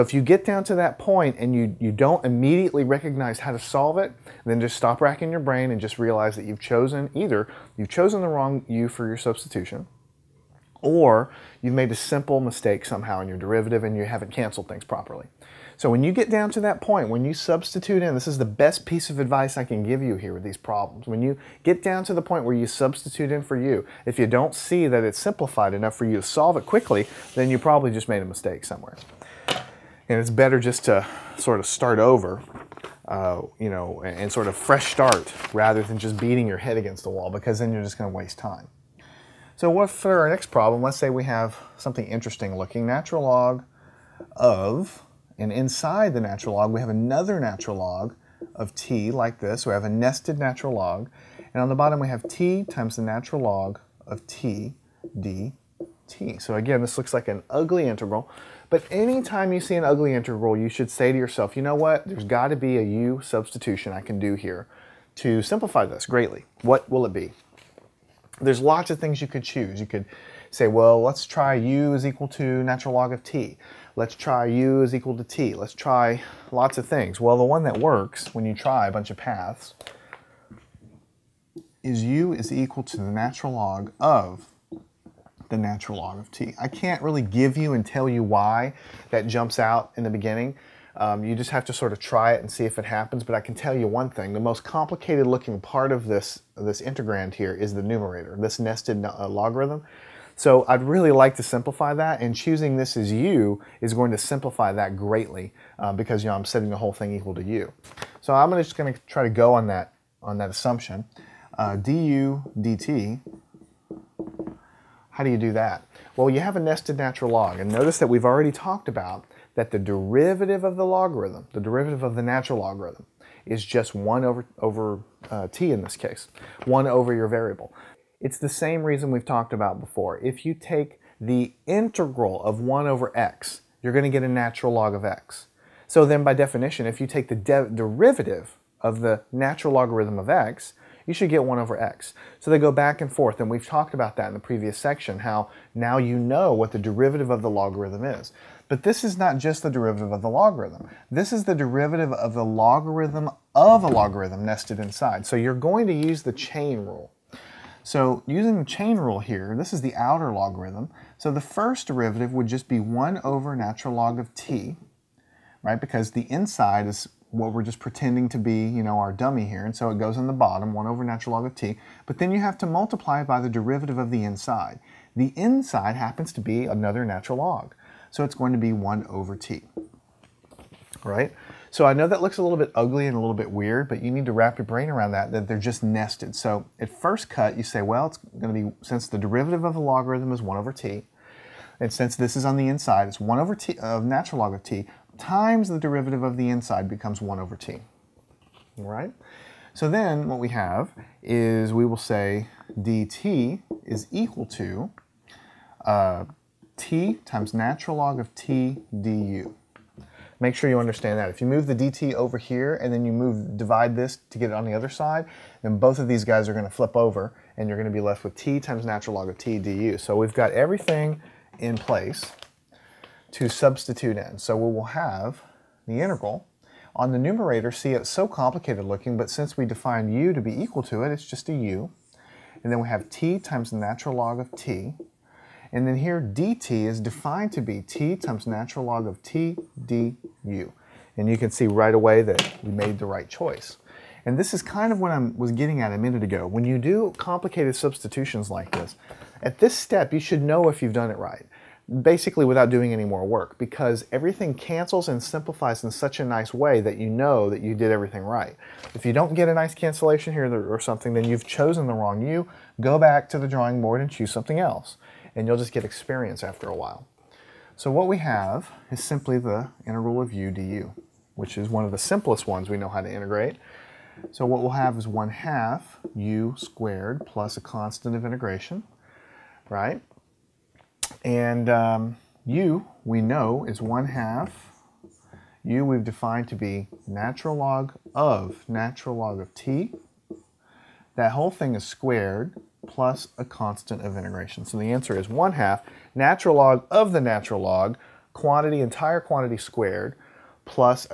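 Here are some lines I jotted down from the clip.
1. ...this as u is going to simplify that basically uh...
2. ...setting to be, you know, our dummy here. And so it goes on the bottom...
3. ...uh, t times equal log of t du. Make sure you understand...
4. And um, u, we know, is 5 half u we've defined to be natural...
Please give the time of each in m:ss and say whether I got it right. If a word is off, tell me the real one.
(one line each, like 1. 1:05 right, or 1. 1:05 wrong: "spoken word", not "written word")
1. 1:42 wrong: "greatly", not "basically"
2. 2:47 wrong: "pretending", not "setting"
3. 3:25 wrong: "natural", not "equal"
4. 4:41 wrong: "1", not "5".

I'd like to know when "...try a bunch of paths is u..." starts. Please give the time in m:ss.
1:18.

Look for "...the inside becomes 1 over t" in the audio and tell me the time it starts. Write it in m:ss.
3:16.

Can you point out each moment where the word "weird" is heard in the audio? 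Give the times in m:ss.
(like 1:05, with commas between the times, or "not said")
3:03.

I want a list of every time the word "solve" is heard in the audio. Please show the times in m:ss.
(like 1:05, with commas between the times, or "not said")
0:03, 0:26.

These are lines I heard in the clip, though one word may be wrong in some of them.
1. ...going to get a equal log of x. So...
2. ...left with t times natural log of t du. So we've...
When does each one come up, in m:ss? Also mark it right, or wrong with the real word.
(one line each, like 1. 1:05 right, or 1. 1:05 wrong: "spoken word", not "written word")
1. 2:13 wrong: "natural", not "equal"
2. 3:37 right.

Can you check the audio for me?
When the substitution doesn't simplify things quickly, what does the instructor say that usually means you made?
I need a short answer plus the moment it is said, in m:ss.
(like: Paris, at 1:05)
A mistake, at 0:28.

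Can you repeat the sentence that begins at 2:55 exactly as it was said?
The inside happens to be another natural log.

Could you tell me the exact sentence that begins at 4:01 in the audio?
And you can see right away that we made the right choice.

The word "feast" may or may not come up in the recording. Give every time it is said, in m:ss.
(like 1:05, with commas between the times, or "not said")
not said.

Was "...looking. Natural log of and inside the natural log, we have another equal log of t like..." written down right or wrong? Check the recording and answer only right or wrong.
wrong.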